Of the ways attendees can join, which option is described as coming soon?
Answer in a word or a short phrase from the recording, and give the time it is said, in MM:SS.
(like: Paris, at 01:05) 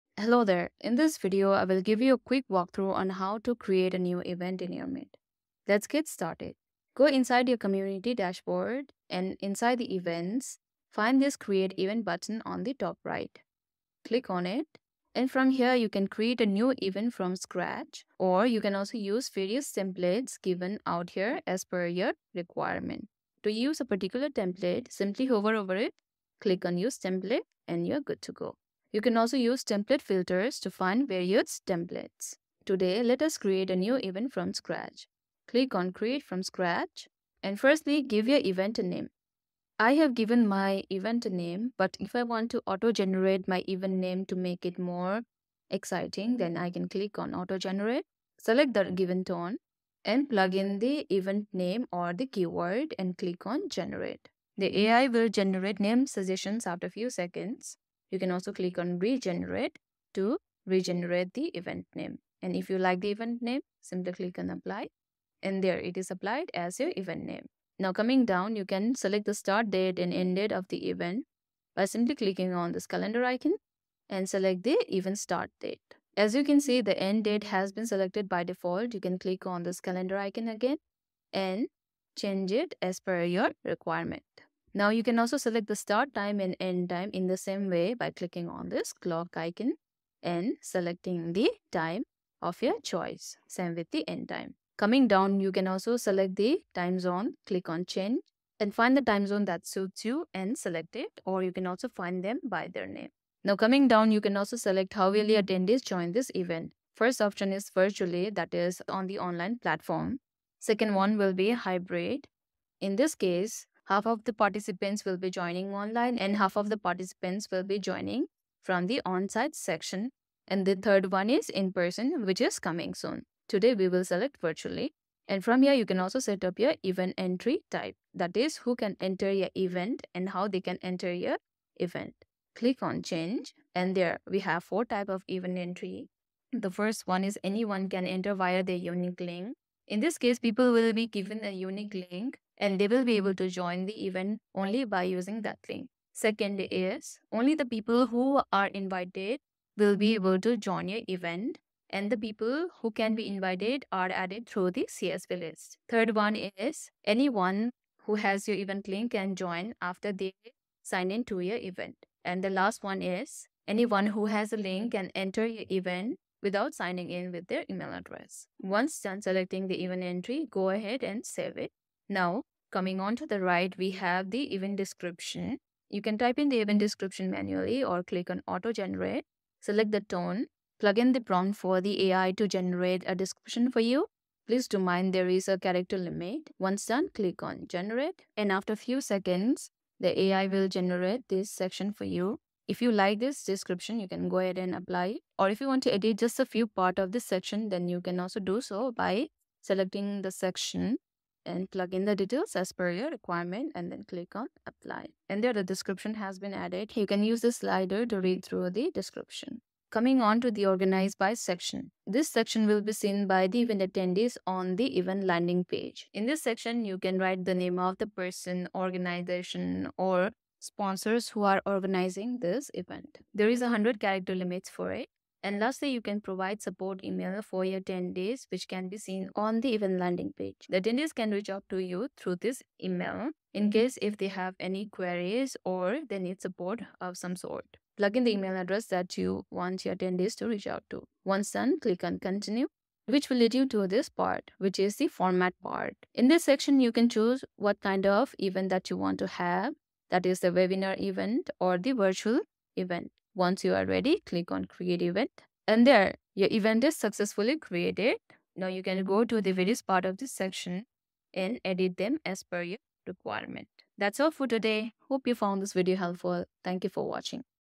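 In person, at 02:01.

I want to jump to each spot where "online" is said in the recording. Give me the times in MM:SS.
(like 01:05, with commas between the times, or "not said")
01:49, 01:55.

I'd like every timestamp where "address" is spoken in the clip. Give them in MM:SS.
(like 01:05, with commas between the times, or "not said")
02:47, 03:58.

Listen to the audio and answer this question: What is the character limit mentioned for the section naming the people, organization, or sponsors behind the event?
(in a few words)
100.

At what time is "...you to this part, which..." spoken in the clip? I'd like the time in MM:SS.
04:03.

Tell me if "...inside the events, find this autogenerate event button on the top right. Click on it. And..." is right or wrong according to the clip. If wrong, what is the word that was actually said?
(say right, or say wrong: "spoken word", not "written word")
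wrong: "create", not "autogenerate".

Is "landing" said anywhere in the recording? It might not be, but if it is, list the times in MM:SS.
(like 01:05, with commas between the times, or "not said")
03:35, 03:49.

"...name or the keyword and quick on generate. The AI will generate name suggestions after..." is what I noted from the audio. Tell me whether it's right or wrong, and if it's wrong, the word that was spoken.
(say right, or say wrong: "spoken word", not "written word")
wrong: "click", not "quick".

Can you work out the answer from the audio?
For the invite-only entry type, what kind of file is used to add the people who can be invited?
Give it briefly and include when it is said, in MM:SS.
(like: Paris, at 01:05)
CSV list, at 02:34.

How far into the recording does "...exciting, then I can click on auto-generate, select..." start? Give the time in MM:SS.
00:45.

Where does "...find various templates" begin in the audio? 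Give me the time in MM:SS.
00:30.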